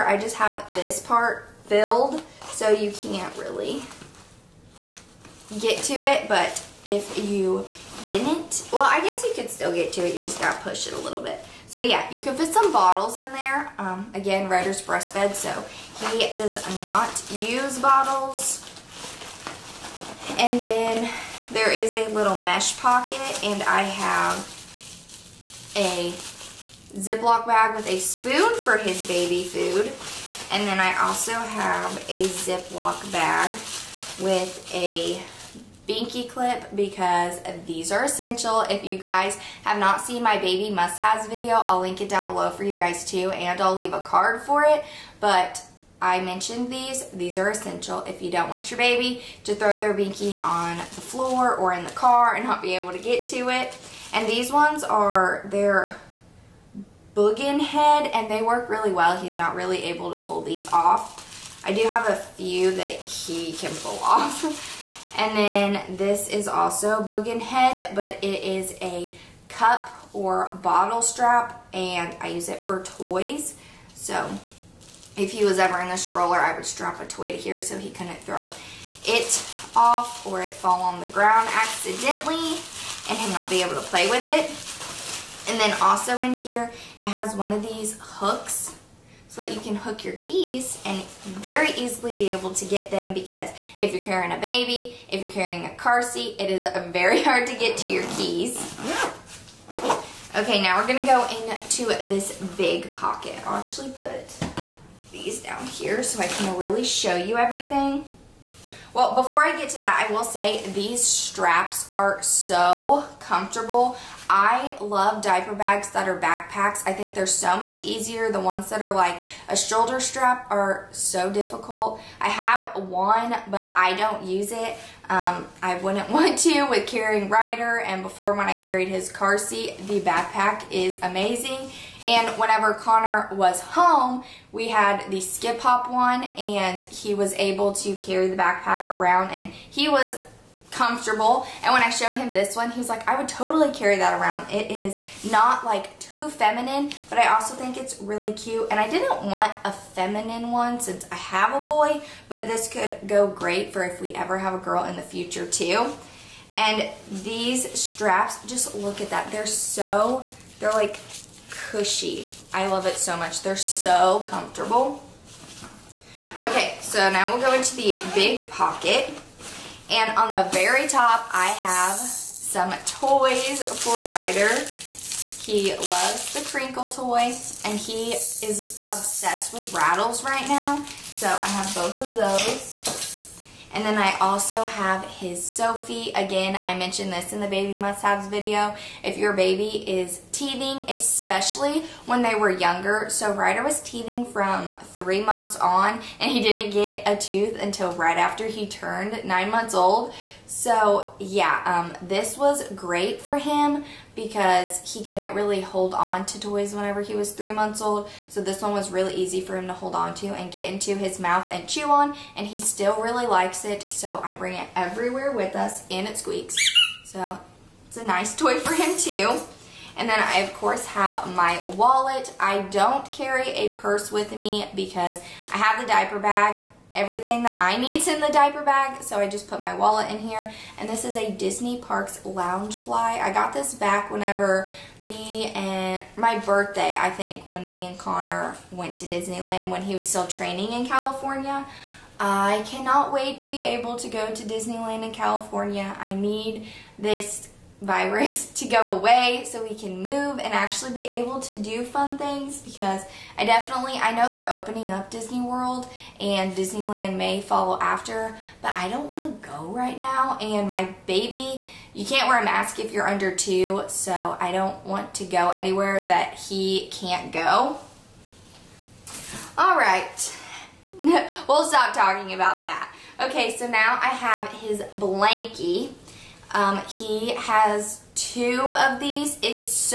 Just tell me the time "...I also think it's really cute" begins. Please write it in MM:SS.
02:27.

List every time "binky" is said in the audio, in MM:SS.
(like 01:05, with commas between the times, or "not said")
00:35, 00:49.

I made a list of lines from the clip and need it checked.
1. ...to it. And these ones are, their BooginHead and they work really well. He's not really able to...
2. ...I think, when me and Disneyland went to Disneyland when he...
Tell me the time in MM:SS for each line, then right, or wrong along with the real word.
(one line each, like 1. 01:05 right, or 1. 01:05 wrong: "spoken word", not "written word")
1. 00:53 right
2. 03:56 wrong: "Connor", not "Disneyland".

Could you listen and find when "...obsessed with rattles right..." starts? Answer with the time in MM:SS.
02:58.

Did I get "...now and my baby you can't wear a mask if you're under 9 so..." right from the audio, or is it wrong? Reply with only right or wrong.
wrong.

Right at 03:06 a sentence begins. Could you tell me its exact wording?
Again, I mentioned this in the baby must-haves video.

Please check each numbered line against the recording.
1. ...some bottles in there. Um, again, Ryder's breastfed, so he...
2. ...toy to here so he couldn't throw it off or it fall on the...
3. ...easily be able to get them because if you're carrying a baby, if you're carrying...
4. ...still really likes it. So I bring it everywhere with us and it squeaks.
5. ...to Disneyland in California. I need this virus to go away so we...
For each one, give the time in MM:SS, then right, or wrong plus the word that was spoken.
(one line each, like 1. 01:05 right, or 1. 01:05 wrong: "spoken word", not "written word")
1. 00:12 right
2. 01:17 right
3. 01:31 right
4. 03:32 right
5. 04:04 right.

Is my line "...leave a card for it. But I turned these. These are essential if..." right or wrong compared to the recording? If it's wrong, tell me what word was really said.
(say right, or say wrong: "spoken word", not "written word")
wrong: "mentioned", not "turned".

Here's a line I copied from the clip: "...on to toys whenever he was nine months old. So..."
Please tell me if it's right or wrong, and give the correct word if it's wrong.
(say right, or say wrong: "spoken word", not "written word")
wrong: "three", not "nine".